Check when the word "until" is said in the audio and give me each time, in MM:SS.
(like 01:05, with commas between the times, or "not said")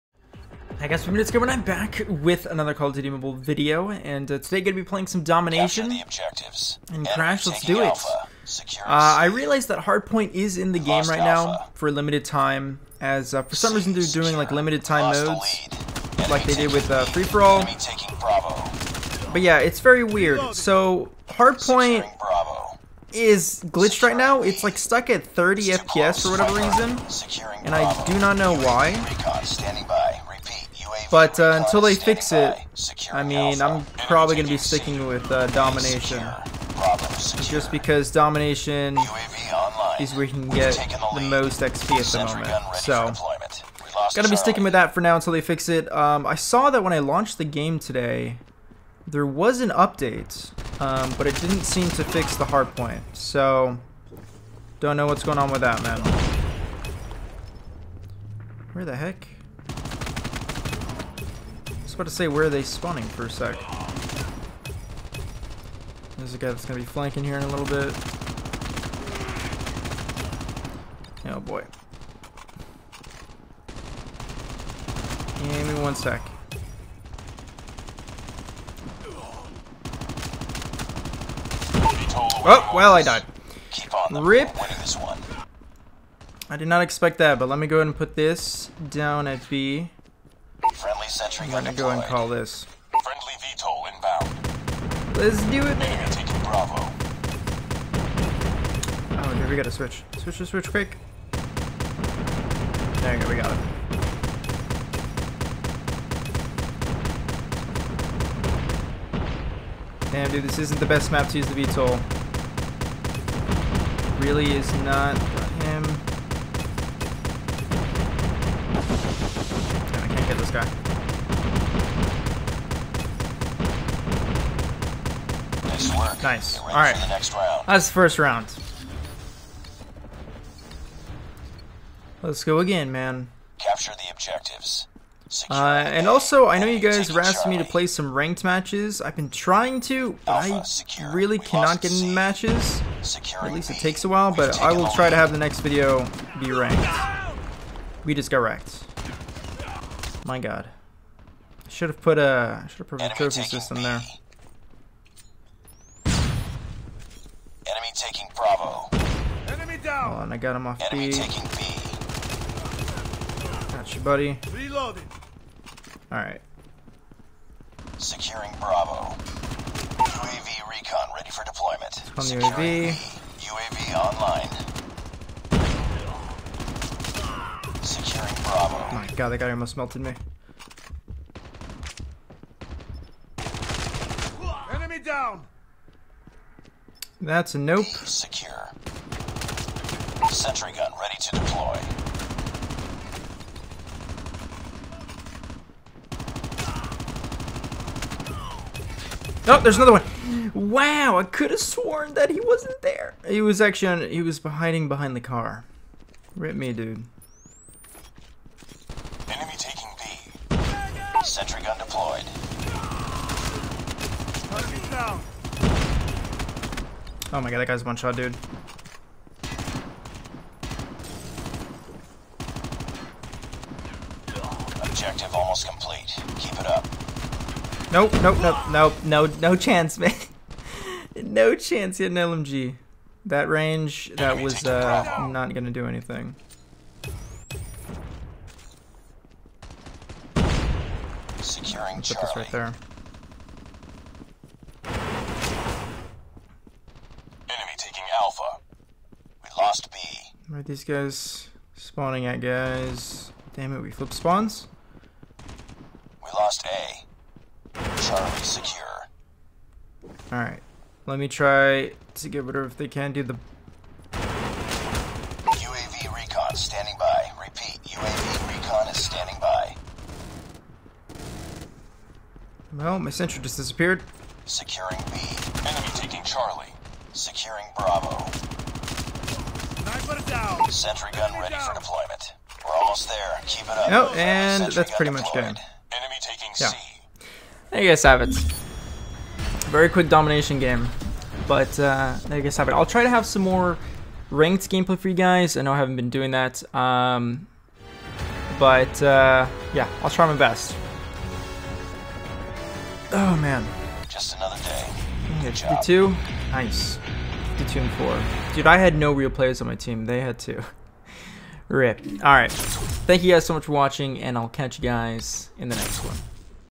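00:31, 00:45.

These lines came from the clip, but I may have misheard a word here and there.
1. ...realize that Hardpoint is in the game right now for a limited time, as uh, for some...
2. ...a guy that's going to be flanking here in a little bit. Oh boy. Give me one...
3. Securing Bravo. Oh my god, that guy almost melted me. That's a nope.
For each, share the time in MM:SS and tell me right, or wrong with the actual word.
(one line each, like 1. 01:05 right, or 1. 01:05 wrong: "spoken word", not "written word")
1. 00:09 right
2. 01:06 right
3. 02:57 right.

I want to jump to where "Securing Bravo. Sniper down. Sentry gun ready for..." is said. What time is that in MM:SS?
04:37.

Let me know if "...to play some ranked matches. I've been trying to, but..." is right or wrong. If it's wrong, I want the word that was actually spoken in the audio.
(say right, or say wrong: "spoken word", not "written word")
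right.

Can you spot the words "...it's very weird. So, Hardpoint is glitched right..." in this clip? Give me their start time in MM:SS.
00:19.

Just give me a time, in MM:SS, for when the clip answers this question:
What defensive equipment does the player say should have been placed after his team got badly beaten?
02:33.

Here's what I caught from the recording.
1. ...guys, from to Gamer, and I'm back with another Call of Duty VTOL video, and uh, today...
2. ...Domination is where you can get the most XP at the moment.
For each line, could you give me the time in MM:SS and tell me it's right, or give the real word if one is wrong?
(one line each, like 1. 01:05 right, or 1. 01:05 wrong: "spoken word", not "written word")
1. 00:00 wrong: "Mobile", not "VTOL"
2. 00:38 right.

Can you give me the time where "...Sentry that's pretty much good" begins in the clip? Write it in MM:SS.
04:44.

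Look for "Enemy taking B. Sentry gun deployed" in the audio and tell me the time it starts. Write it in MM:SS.
03:29.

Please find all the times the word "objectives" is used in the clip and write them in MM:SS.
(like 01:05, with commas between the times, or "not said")
00:06, 02:14, 03:44.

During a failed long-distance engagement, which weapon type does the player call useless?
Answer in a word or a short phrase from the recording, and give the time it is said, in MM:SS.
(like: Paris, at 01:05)
LMG, at 03:52.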